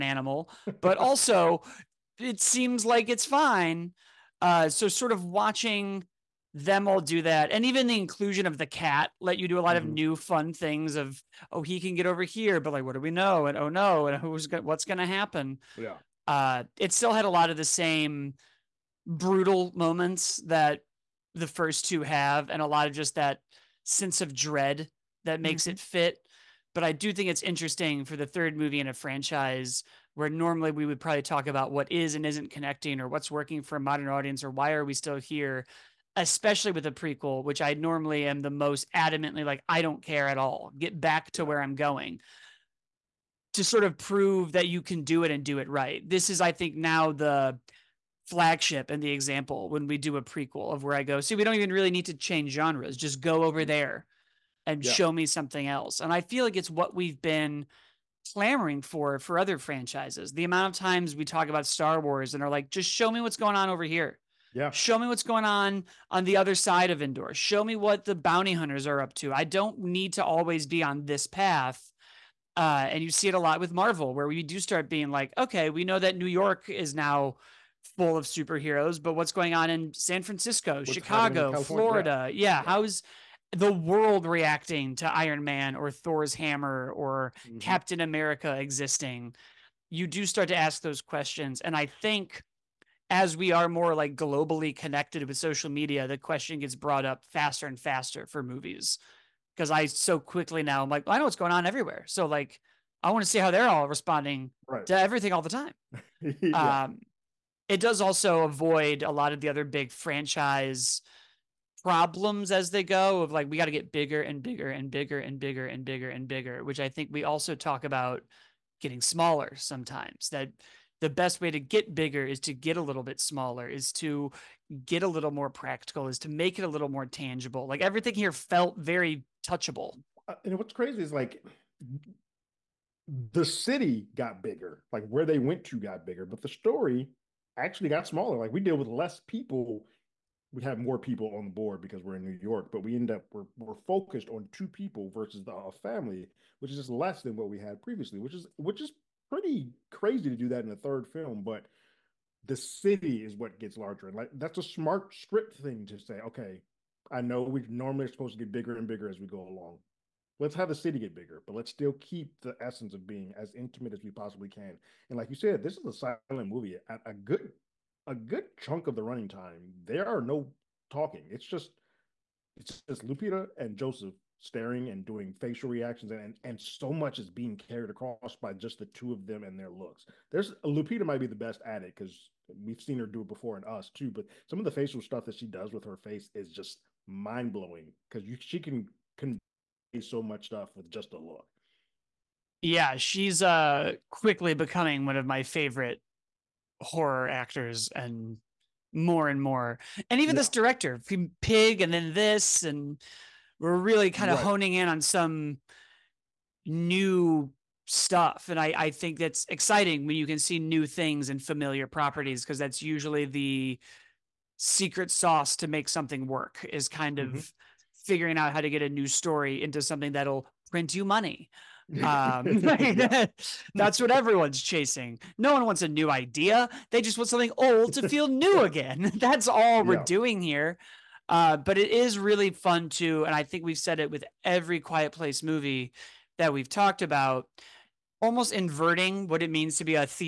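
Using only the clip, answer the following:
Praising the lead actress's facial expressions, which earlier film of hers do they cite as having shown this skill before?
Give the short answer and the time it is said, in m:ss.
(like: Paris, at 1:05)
Us, at 3:03.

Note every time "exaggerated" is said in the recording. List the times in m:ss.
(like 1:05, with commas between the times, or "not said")
not said.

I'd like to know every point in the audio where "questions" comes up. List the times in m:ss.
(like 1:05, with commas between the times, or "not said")
1:30, 1:36.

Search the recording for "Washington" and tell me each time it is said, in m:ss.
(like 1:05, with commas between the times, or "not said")
not said.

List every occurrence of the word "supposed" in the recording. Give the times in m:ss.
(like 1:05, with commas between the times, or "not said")
2:38.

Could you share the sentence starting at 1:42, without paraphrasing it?
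So like, I want to see how they're all responding right.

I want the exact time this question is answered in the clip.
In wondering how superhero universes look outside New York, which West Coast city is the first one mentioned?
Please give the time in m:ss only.
1:19.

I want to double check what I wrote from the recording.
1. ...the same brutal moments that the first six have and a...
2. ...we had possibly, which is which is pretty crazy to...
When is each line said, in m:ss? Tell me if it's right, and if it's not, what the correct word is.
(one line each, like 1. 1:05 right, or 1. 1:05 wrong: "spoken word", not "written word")
1. 0:17 wrong: "two", not "six"
2. 2:27 wrong: "previously", not "possibly".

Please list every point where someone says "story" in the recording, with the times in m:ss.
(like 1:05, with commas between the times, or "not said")
2:16, 3:39.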